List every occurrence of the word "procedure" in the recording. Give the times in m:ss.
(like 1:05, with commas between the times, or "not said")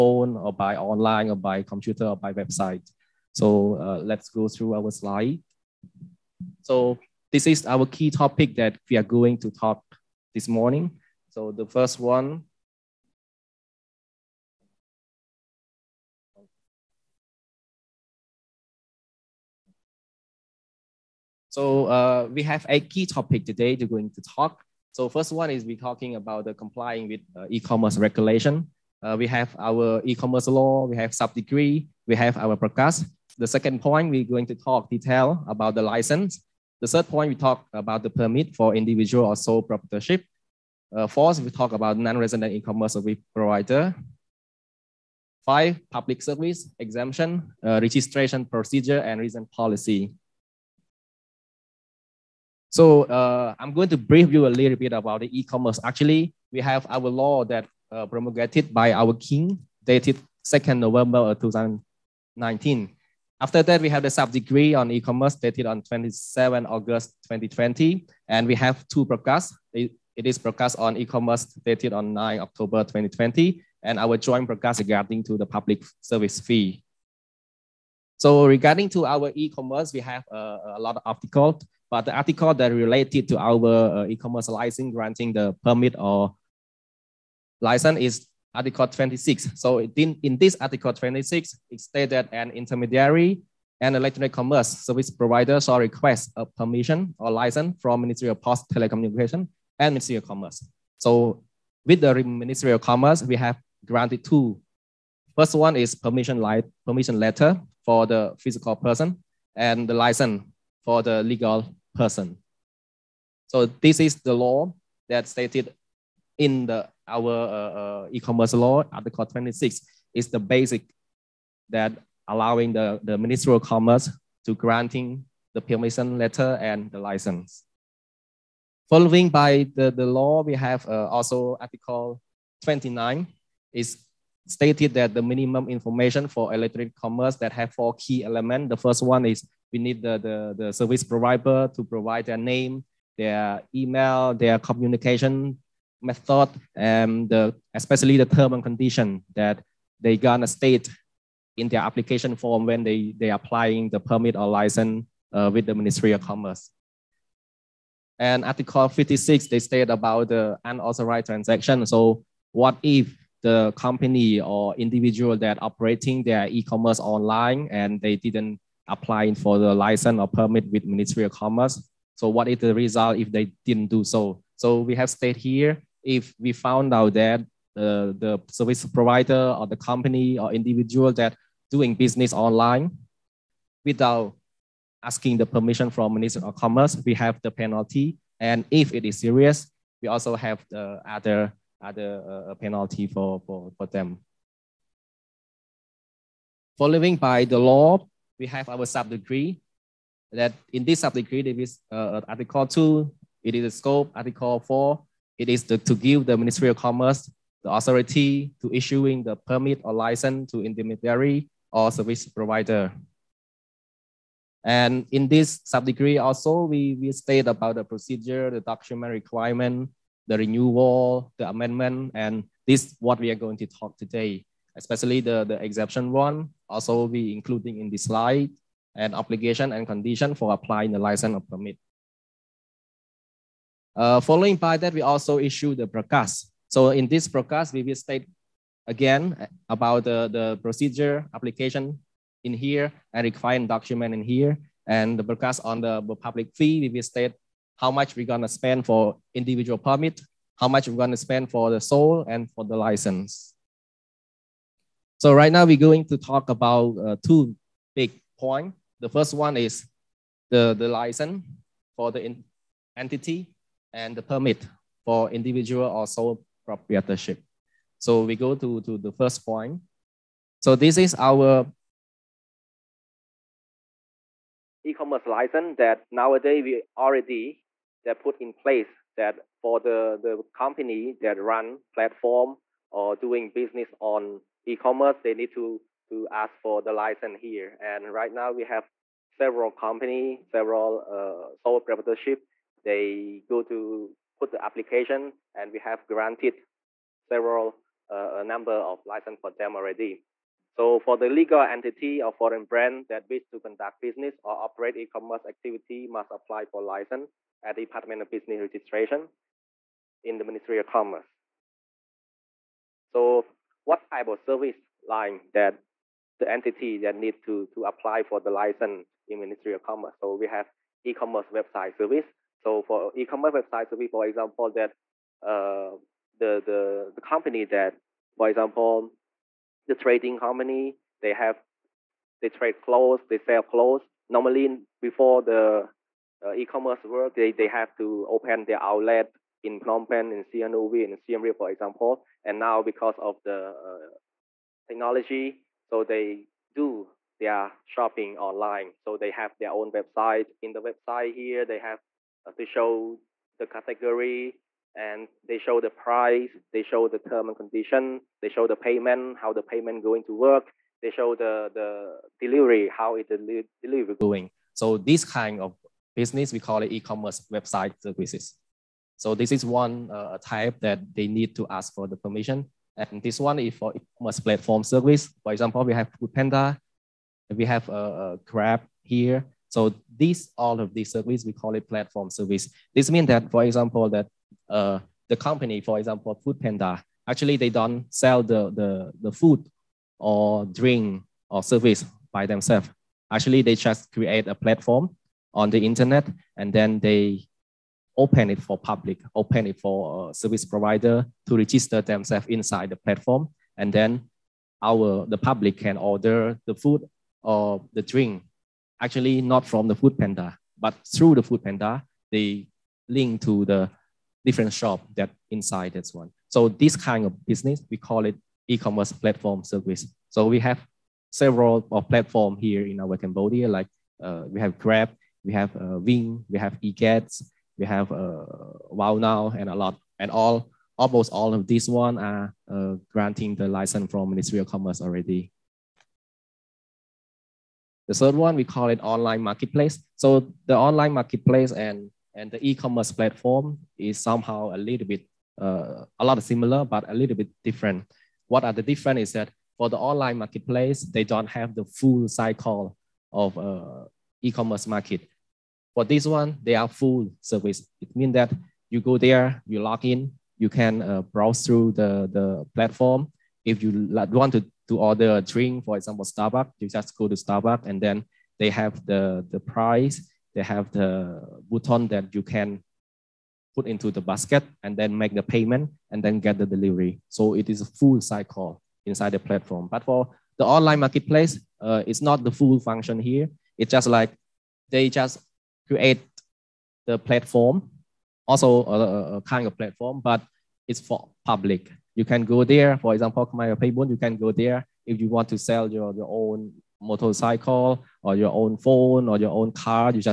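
0:48, 3:37, 4:00.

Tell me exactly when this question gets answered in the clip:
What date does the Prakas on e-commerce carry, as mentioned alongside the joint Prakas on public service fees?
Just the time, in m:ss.
1:12.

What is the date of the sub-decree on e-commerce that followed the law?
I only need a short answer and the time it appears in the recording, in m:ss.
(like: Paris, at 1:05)
27 August 2020, at 1:05.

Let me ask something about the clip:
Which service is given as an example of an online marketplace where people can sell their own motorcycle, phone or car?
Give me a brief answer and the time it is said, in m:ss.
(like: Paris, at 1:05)
Khmer Paybun, at 8:13.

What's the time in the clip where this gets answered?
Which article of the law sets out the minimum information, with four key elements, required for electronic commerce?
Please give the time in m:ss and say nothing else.
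2:11.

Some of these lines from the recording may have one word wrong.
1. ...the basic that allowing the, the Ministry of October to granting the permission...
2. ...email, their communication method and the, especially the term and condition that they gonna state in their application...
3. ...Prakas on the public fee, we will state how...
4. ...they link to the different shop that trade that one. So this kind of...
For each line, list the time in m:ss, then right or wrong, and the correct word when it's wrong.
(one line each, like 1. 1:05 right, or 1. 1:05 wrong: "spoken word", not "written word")
1. 2:00 wrong: "Commerce", not "October"
2. 2:23 right
3. 4:05 right
4. 6:52 wrong: "inside", not "trade".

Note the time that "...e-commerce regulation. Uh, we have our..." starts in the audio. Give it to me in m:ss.
0:27.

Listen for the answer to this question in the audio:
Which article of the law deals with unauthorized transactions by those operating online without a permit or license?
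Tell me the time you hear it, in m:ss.
2:38.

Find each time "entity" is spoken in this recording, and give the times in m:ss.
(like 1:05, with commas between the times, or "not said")
4:22, 5:01, 5:16.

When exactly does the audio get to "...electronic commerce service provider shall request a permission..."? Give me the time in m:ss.
1:33.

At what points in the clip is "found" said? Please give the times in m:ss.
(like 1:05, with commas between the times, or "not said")
2:56.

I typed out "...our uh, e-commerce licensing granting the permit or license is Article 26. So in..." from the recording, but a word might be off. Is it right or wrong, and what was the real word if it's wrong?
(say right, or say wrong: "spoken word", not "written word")
right.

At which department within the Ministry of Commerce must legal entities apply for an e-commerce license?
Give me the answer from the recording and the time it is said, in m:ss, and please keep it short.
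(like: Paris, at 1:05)
Department of Business Registration, at 5:07.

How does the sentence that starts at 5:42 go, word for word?
And now because of the uh, technology, so they do their shopping online.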